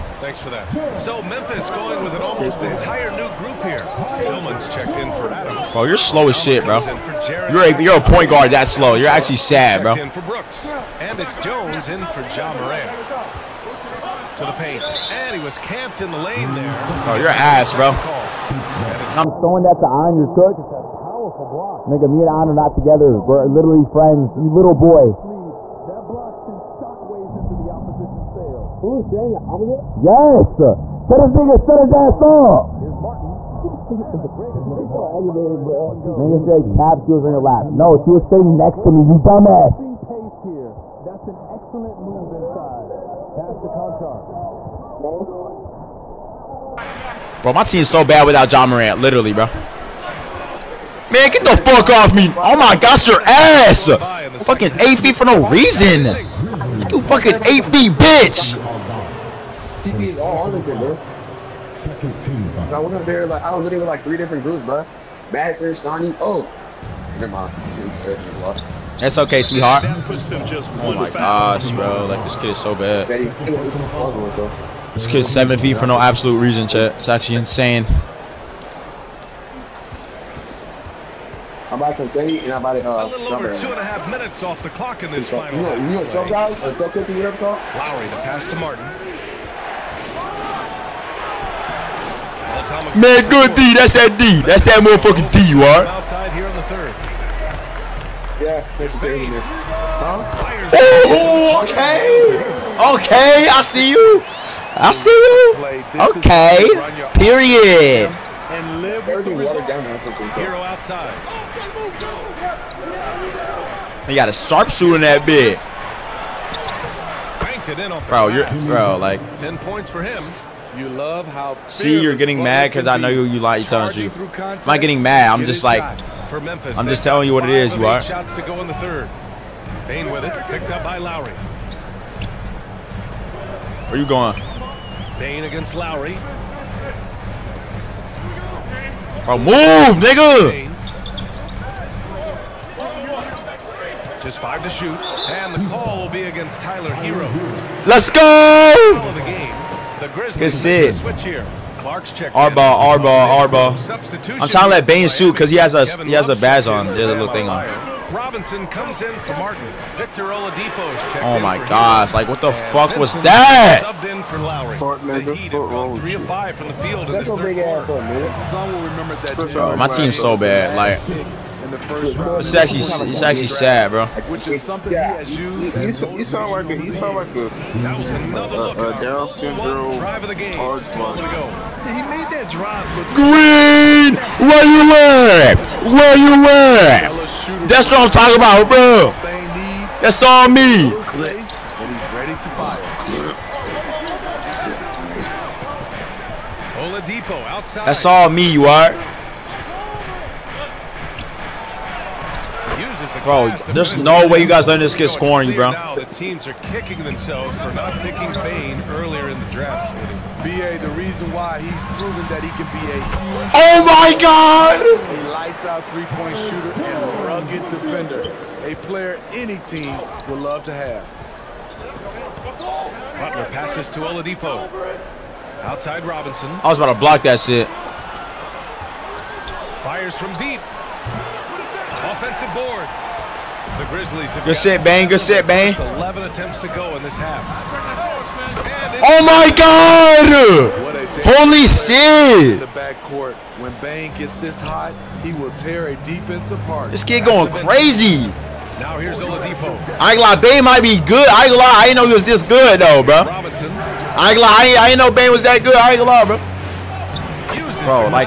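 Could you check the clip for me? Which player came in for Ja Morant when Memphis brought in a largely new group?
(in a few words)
Jones.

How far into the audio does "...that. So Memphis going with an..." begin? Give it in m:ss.
0:00.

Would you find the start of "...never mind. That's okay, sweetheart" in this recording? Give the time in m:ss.
1:07.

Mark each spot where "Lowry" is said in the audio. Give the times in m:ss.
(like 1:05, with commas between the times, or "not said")
1:26, 2:10, 2:15, 2:44.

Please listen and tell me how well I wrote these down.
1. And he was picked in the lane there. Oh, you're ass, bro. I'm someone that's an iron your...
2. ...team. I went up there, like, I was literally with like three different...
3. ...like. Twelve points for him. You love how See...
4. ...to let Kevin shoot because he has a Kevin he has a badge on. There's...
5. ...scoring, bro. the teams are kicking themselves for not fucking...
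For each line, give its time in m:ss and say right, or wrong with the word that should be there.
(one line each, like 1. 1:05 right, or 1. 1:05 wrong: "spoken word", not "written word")
1. 0:15 wrong: "camped", not "picked"
2. 1:02 right
3. 1:58 wrong: "Ten", not "Twelve"
4. 2:34 wrong: "Bane", not "Kevin"
5. 3:25 wrong: "picking", not "fucking".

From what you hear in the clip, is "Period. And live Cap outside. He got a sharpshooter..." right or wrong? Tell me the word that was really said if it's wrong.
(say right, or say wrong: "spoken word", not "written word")
wrong: "Herro", not "Cap".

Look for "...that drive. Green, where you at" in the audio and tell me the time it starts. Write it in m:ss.
3:02.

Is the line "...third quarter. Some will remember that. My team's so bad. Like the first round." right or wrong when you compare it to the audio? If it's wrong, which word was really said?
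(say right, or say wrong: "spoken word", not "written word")
right.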